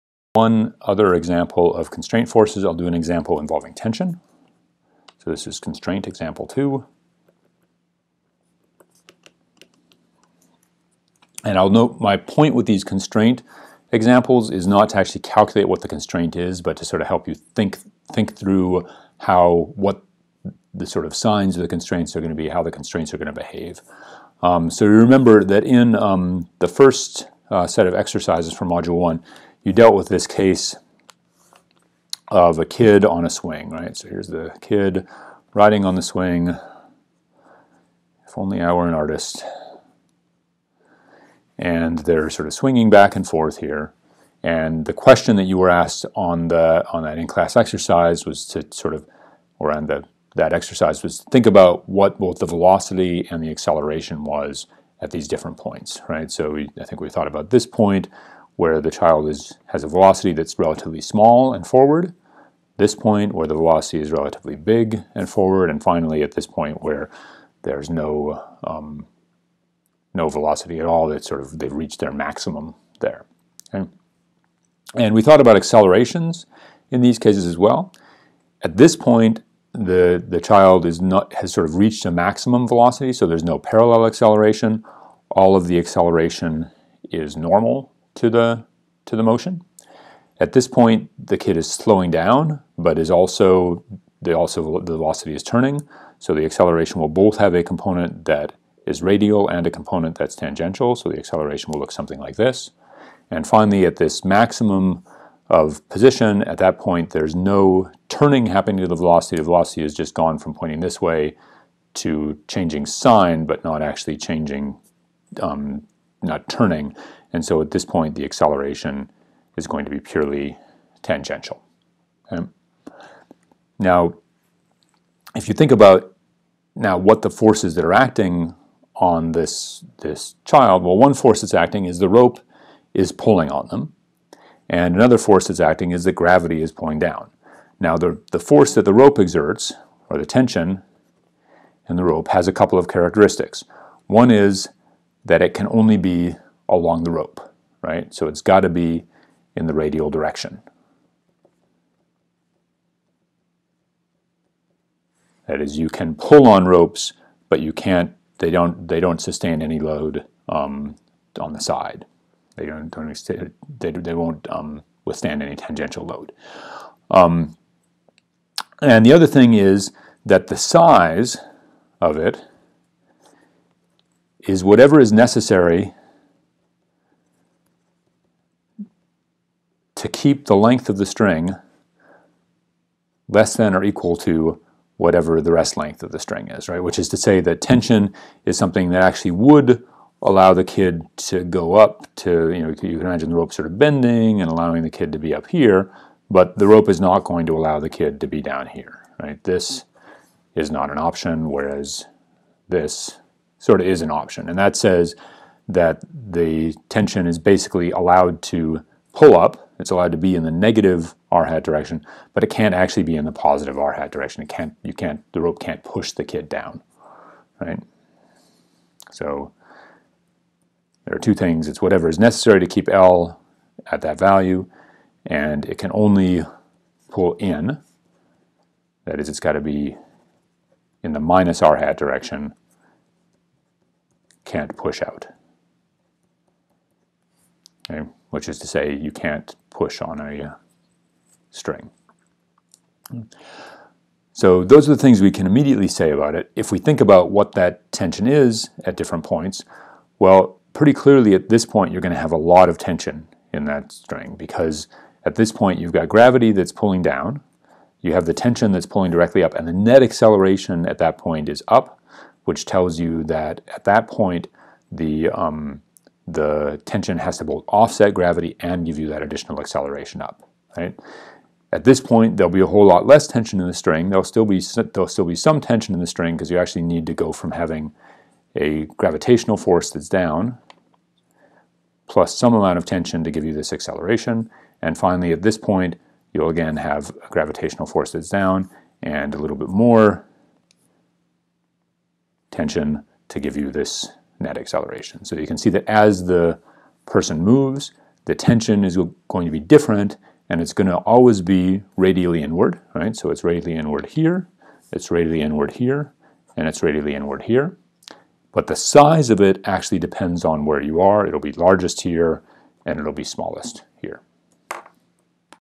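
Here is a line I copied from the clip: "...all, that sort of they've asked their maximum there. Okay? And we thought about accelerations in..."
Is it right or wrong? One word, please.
wrong.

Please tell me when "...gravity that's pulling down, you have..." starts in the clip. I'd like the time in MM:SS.
04:16.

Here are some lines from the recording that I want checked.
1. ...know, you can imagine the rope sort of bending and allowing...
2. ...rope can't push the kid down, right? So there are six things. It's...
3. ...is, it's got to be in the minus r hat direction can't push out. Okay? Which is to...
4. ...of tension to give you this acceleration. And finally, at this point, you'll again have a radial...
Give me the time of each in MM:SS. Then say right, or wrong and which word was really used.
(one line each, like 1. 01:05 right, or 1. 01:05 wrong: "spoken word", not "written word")
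1. 03:12 right
2. 03:35 wrong: "two", not "six"
3. 03:49 right
4. 04:42 wrong: "gravitational", not "radial".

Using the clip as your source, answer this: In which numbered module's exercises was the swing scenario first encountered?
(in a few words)
Module 1.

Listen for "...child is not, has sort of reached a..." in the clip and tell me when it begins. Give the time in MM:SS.
01:20.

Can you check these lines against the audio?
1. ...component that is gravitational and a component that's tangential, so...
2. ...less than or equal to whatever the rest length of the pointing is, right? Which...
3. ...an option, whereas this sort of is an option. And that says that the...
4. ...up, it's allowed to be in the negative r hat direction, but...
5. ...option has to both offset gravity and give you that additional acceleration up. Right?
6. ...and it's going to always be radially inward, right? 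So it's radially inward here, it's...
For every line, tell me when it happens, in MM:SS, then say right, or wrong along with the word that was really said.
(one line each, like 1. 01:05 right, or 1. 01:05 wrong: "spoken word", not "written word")
1. 01:37 wrong: "radial", not "gravitational"
2. 03:03 wrong: "string", not "pointing"
3. 03:20 right
4. 03:29 right
5. 04:26 wrong: "tension", not "option"
6. 05:00 right.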